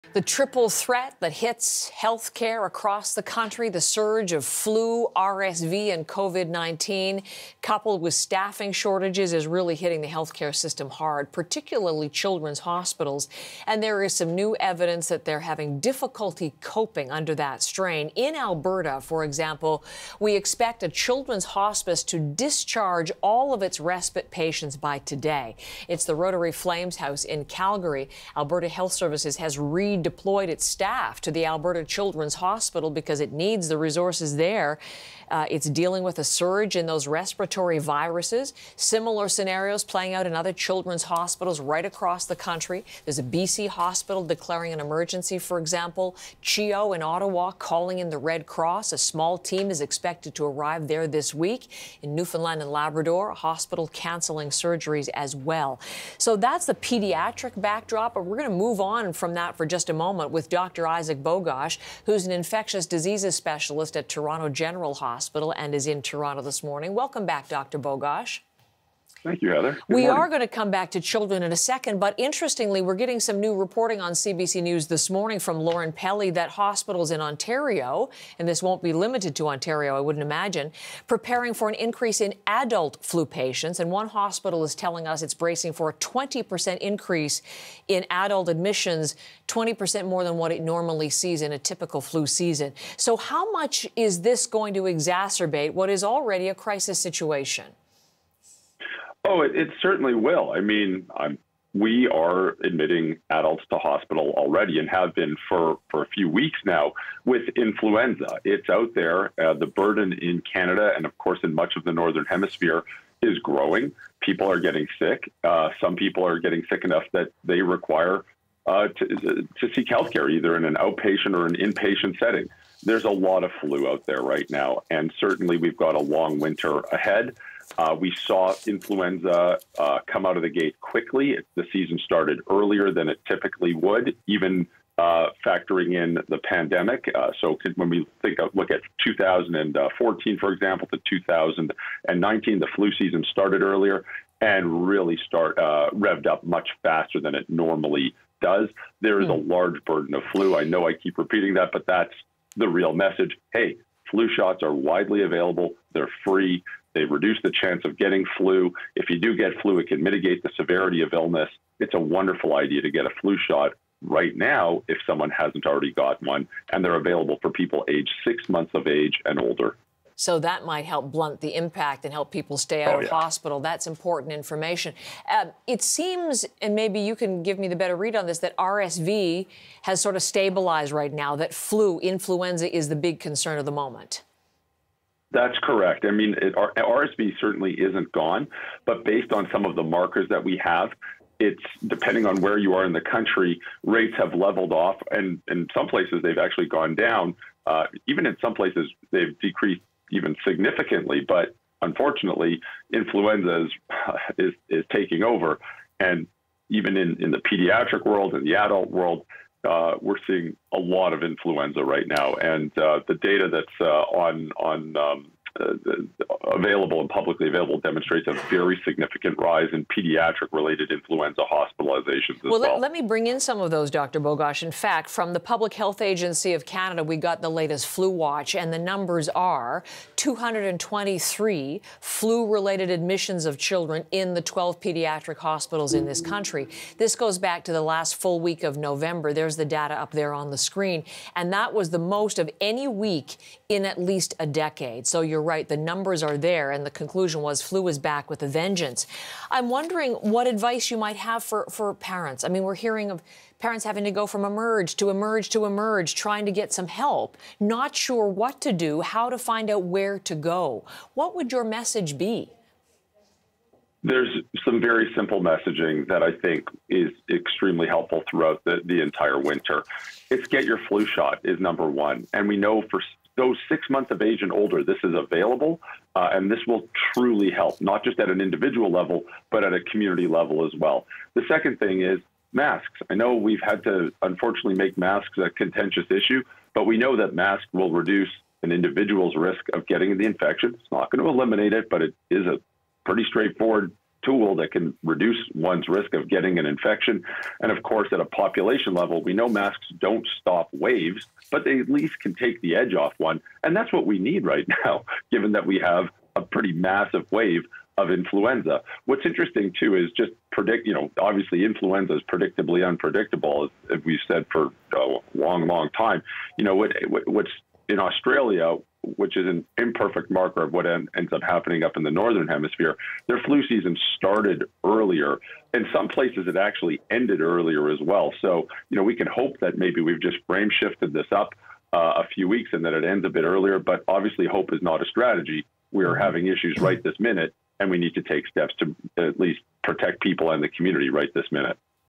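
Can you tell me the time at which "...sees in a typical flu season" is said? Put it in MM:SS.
01:31.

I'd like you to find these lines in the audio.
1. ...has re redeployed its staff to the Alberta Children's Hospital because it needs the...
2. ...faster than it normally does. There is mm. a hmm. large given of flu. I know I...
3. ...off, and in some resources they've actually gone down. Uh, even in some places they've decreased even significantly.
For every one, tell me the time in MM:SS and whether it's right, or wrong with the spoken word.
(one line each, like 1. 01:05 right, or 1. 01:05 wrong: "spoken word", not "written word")
1. 00:29 right
2. 02:26 wrong: "burden", not "given"
3. 03:14 wrong: "places", not "resources".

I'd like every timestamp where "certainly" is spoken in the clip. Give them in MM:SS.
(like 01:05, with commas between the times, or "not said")
01:39, 02:05, 03:07.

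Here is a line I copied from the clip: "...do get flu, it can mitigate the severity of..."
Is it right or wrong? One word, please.
right.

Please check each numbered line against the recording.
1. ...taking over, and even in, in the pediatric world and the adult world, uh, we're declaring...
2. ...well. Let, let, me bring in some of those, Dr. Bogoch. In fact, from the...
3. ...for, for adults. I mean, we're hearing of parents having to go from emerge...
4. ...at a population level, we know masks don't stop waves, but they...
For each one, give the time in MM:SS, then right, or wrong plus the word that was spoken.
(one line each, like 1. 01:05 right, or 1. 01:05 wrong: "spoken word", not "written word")
1. 03:24 wrong: "seeing", not "declaring"
2. 03:42 right
3. 04:11 wrong: "parents", not "adults"
4. 04:58 right.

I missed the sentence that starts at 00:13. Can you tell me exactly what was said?
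And there is some new evidence that they're having difficulty coping under that strain.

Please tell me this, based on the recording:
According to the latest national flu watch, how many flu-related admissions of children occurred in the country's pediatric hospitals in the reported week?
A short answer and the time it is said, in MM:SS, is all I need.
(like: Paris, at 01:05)
223, at 03:50.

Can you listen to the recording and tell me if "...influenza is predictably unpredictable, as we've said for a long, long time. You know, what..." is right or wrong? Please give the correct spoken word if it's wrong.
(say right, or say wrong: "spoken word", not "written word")
right.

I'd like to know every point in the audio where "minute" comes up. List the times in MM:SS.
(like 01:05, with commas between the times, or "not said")
05:37, 05:41.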